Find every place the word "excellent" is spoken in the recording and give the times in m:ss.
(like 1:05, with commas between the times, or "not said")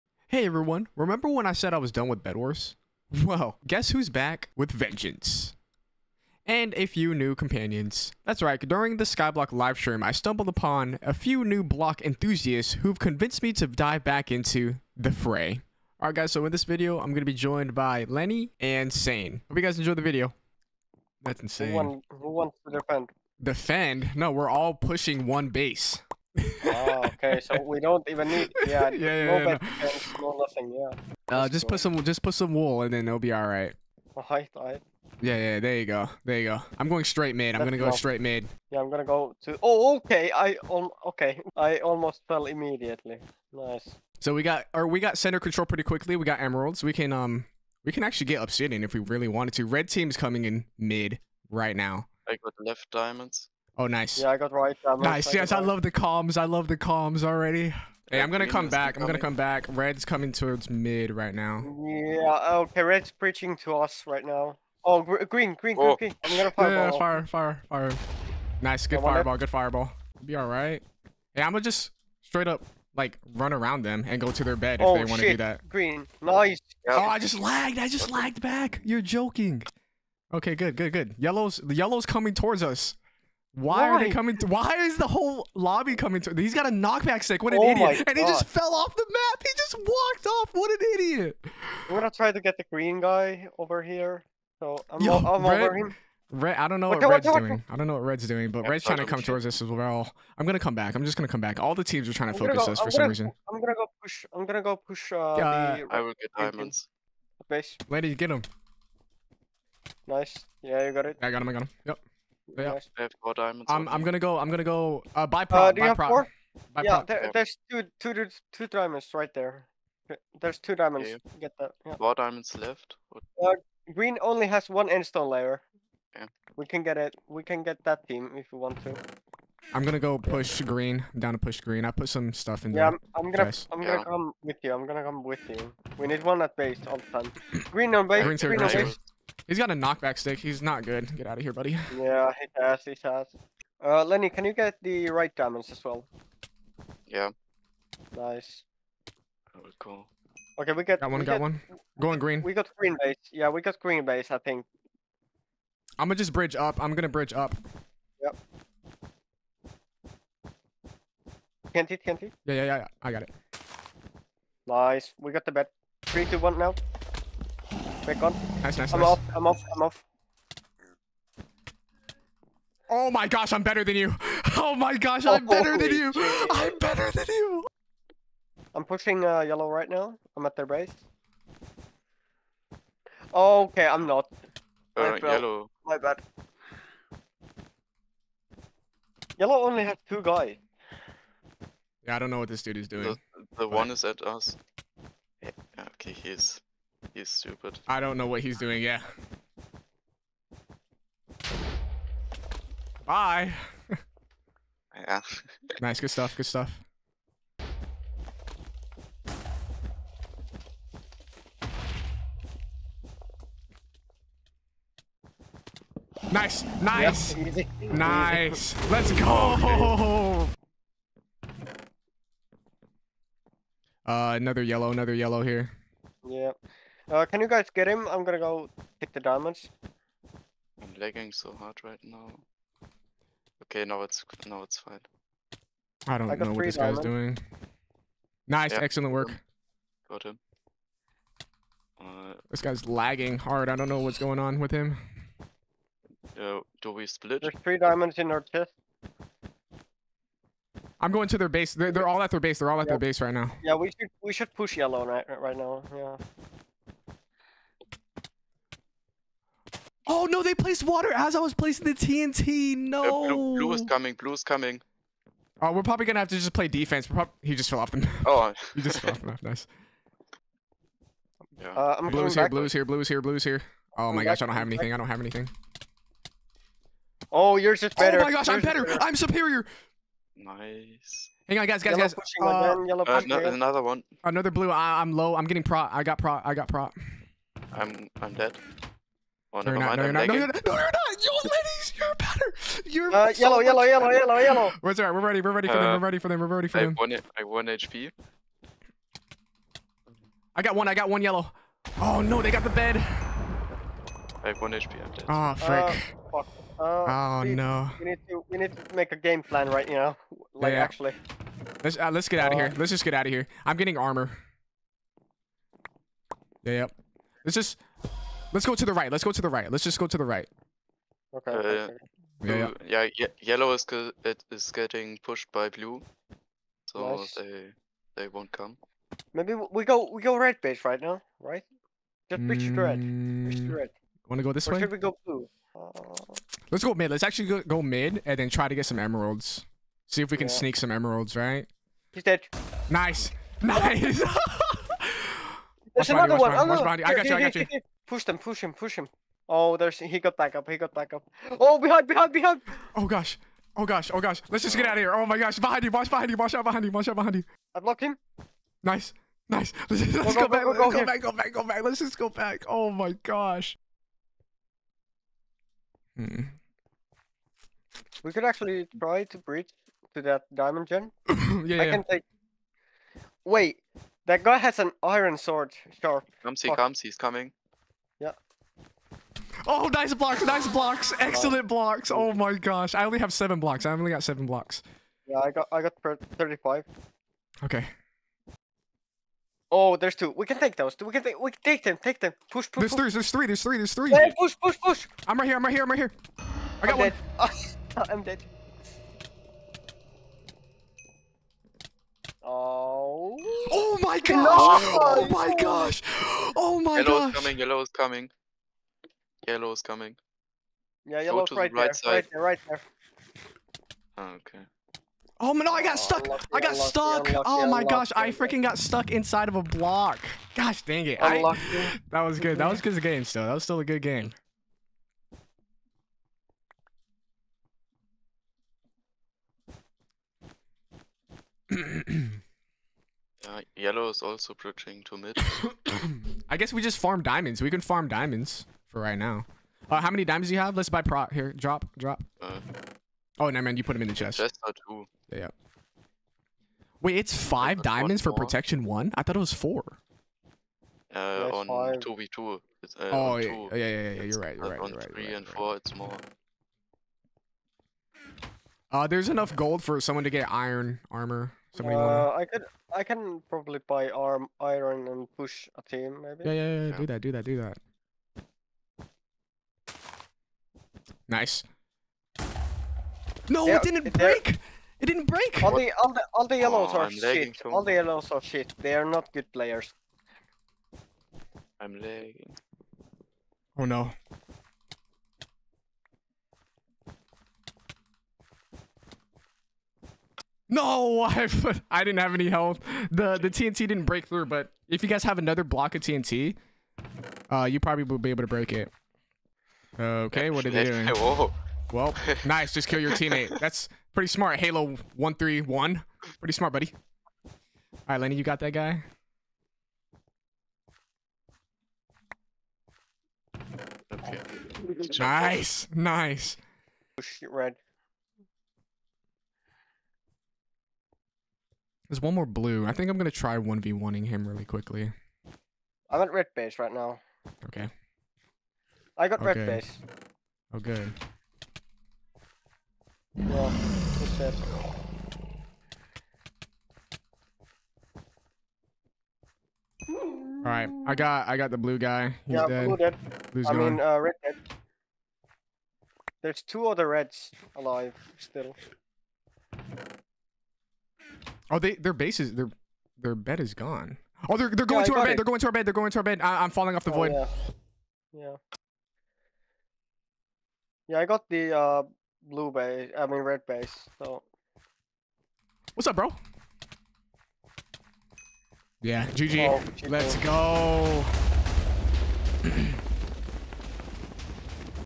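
3:58, 6:21.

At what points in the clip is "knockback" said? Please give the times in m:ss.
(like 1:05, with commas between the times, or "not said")
1:26, 2:19.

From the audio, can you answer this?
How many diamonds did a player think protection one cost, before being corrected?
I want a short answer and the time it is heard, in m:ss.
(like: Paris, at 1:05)
4, at 7:29.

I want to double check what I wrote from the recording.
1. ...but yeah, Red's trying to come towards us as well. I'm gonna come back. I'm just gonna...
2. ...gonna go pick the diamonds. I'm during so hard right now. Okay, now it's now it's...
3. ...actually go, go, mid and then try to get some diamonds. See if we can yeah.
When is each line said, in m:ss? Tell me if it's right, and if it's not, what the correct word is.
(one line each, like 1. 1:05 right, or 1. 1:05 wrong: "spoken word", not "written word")
1. 1:38 right
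2. 3:48 wrong: "lagging", not "during"
3. 5:37 wrong: "emeralds", not "diamonds".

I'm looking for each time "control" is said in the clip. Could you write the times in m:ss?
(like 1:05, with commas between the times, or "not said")
0:45.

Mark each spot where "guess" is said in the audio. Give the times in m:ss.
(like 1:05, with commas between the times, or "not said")
0:03, 7:16.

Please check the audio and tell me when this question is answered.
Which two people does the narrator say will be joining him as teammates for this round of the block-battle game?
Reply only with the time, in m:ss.
0:18.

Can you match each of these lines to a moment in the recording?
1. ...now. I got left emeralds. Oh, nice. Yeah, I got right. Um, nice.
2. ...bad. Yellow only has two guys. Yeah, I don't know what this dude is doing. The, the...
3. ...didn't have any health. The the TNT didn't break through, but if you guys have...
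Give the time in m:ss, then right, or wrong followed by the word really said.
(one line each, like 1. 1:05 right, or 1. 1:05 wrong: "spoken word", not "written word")
1. 0:51 wrong: "diamonds", not "emeralds"
2. 3:05 right
3. 8:12 right.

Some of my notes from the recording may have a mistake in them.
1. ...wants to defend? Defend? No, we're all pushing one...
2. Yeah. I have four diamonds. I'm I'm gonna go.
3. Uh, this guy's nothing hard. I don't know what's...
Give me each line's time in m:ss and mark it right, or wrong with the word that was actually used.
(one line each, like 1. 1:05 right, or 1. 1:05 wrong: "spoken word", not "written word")
1. 0:22 right
2. 1:52 right
3. 4:01 wrong: "lagging", not "nothing".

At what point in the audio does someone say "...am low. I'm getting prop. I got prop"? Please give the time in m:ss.
4:45.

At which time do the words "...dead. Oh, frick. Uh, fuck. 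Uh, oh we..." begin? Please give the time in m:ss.
5:05.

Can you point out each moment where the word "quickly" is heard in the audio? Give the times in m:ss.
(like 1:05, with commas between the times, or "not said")
0:45, 8:44.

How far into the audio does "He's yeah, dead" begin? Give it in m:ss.
9:02.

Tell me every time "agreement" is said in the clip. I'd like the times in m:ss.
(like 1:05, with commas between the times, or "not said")
not said.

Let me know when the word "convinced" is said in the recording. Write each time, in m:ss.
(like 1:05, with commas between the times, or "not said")
0:12.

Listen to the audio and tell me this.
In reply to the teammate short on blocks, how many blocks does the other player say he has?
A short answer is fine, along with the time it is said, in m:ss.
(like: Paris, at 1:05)
35, at 6:26.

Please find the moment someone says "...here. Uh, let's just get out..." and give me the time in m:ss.
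5:12.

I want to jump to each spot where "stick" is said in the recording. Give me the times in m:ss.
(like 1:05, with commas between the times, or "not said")
1:27, 2:20.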